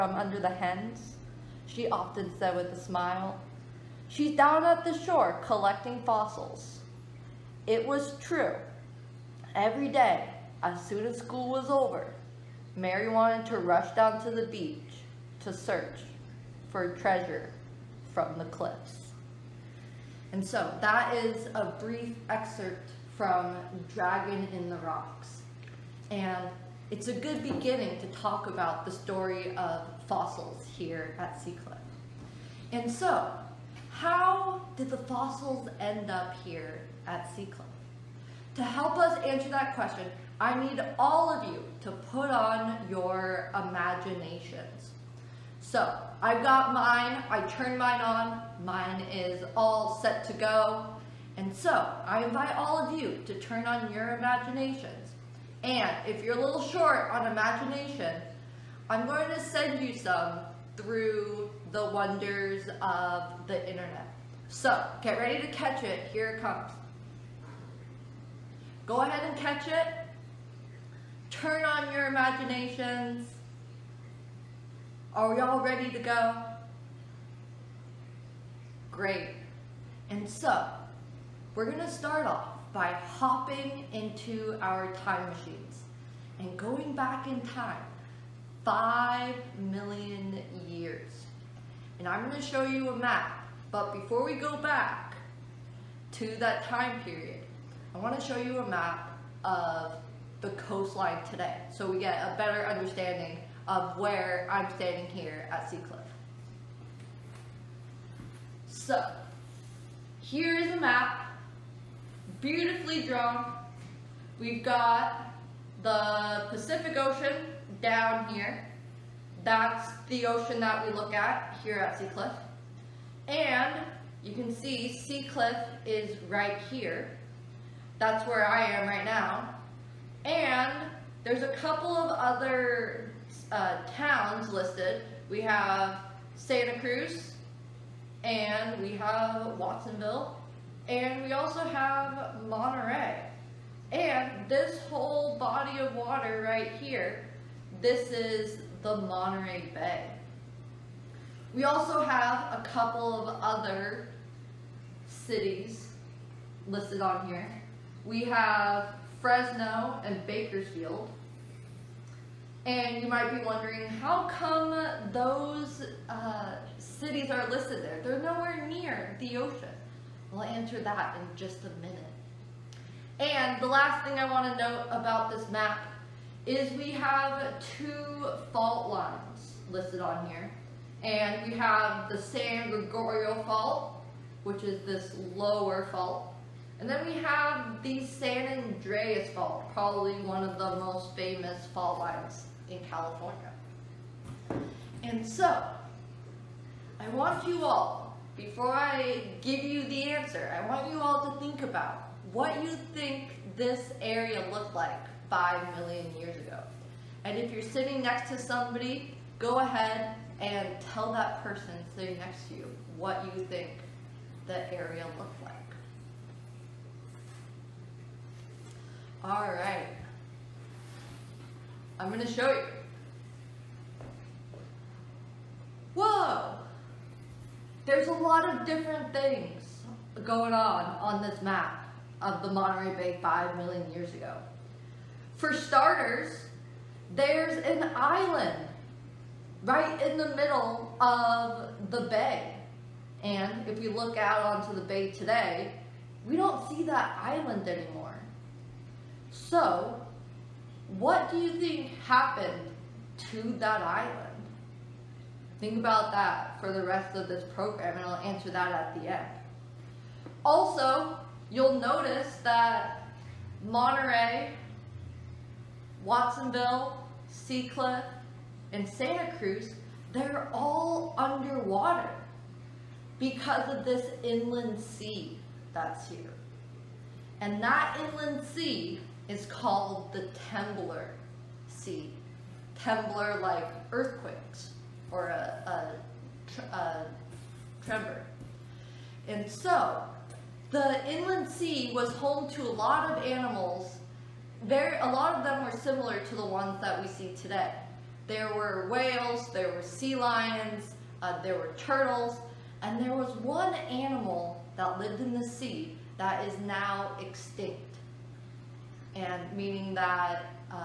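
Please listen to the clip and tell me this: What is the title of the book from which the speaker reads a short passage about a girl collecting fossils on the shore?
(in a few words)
Dragon in the Rocks.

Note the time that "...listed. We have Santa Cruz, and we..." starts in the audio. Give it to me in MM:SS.
02:14.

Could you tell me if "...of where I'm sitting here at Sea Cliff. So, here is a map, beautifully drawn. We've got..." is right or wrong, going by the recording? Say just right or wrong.
wrong.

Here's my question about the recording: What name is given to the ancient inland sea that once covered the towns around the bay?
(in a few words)
Temblor Sea.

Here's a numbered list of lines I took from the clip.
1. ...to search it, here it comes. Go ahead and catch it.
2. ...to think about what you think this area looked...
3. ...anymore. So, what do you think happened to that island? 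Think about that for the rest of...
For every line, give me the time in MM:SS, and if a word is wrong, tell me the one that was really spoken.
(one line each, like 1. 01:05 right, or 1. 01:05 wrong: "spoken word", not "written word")
1. 01:05 wrong: "catch", not "search"
2. 03:21 right
3. 04:07 right.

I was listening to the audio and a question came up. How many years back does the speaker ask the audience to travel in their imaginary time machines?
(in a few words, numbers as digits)
5 million years.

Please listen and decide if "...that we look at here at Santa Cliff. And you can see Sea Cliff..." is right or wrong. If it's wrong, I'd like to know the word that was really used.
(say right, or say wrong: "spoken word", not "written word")
wrong: "Sea", not "Santa".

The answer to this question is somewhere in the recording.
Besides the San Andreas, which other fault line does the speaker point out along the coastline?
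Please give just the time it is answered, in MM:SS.
03:02.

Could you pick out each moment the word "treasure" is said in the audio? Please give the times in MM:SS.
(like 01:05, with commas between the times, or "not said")
00:16.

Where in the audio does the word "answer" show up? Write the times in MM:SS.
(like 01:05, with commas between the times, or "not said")
00:39, 02:50, 03:20, 04:18.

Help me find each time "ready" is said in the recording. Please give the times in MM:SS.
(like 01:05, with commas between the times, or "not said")
01:05, 01:15.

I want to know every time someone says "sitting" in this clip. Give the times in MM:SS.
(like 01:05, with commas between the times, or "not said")
03:27, 03:31.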